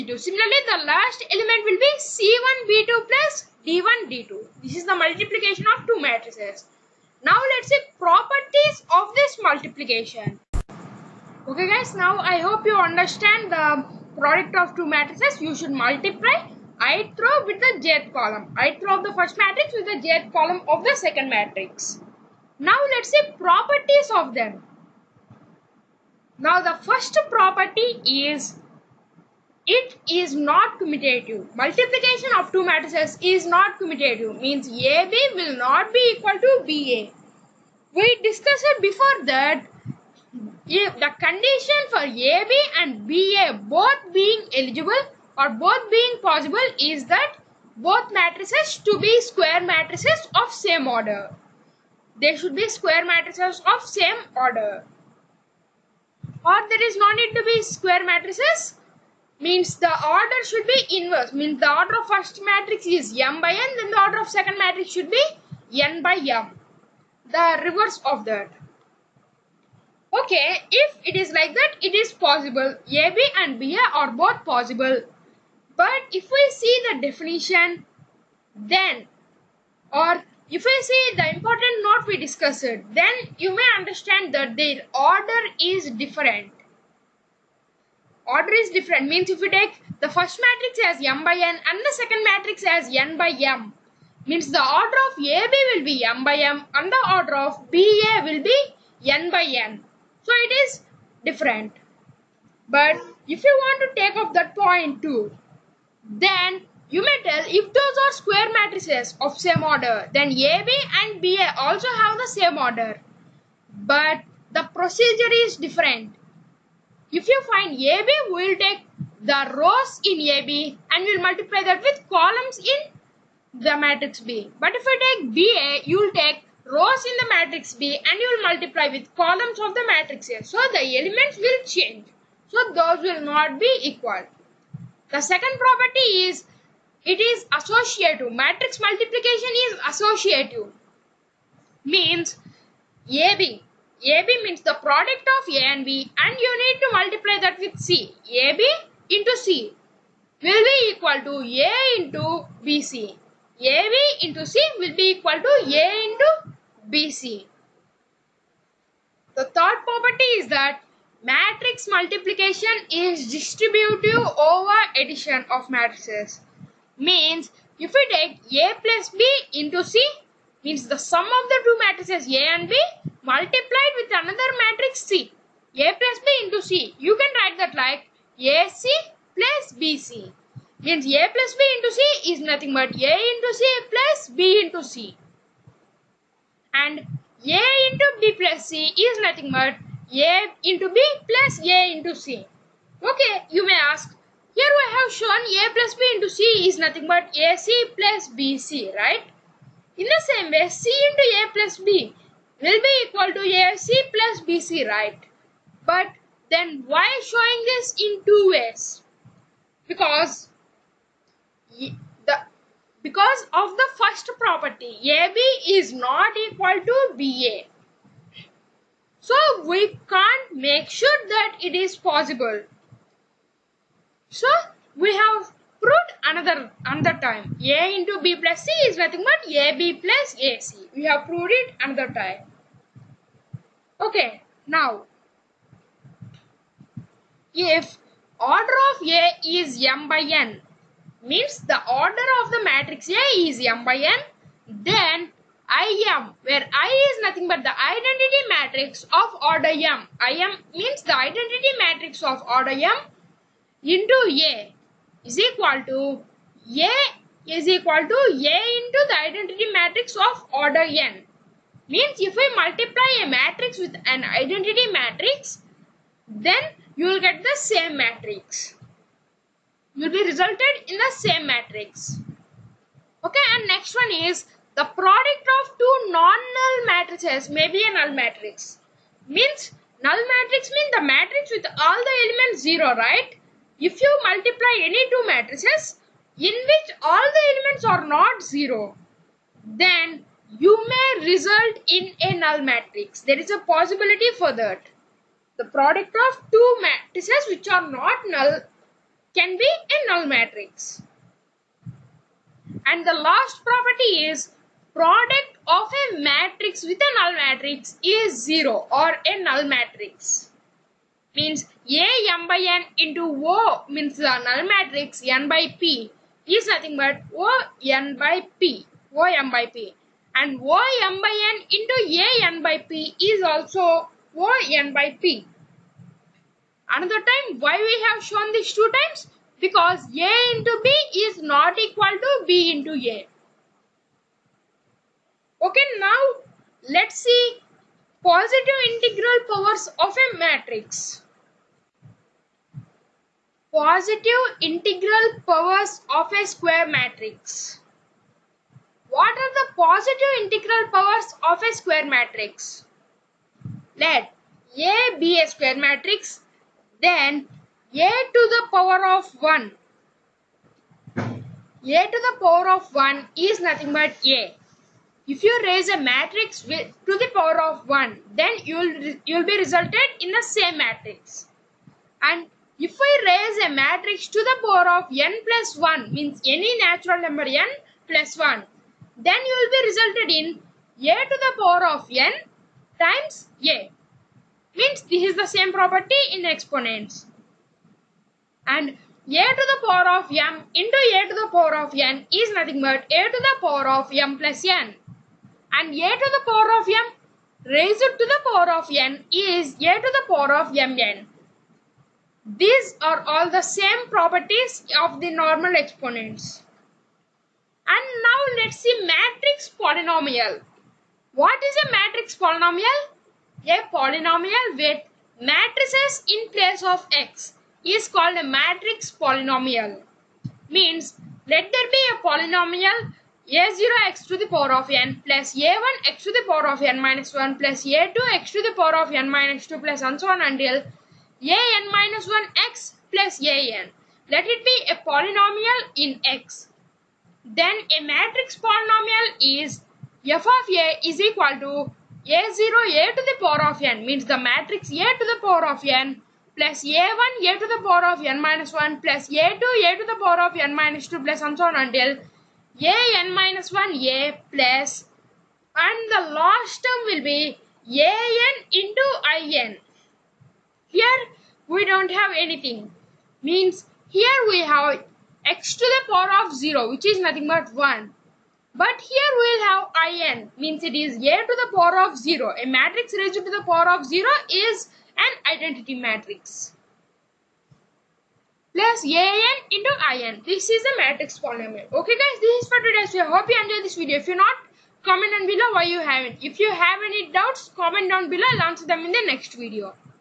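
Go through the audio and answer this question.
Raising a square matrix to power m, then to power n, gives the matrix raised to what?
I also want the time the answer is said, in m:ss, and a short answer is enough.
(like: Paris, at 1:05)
mn, at 6:39.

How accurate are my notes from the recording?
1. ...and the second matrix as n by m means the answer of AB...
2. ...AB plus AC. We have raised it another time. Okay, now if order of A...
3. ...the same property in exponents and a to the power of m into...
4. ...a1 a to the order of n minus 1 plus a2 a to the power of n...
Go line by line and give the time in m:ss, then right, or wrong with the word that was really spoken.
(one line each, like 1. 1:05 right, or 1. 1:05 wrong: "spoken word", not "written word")
1. 1:31 wrong: "order", not "answer"
2. 3:49 wrong: "proved", not "raised"
3. 6:25 right
4. 7:26 wrong: "power", not "order".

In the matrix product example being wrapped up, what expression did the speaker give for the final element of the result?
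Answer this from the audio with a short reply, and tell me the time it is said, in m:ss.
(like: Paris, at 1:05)
C1B2 + D1D2, at 0:01.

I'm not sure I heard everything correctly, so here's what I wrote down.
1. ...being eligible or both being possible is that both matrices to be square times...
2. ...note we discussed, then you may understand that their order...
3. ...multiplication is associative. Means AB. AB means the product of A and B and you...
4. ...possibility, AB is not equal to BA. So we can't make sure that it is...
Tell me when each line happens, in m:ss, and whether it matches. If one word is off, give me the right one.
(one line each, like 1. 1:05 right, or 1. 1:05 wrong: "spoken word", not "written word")
1. 0:44 wrong: "matrices", not "times"
2. 1:21 right
3. 2:18 right
4. 3:34 wrong: "property", not "possibility".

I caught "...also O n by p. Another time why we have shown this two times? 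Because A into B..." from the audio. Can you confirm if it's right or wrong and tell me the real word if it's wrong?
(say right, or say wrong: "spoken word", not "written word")
right.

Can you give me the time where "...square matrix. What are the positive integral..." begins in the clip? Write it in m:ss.
5:46.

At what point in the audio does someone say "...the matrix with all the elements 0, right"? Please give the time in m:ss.
4:40.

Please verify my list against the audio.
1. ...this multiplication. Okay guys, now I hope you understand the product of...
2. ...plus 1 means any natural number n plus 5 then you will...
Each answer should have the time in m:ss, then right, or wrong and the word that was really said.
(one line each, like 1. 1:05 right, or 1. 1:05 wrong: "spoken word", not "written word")
1. 0:09 right
2. 6:15 wrong: "1", not "5".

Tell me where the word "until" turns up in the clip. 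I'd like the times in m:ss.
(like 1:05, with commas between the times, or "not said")
7:10, 7:31.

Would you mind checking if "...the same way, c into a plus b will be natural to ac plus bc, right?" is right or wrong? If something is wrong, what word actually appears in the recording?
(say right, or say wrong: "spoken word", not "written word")
wrong: "equal", not "natural".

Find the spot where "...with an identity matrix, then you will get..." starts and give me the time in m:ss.
4:23.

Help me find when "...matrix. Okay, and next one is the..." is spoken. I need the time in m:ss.
4:31.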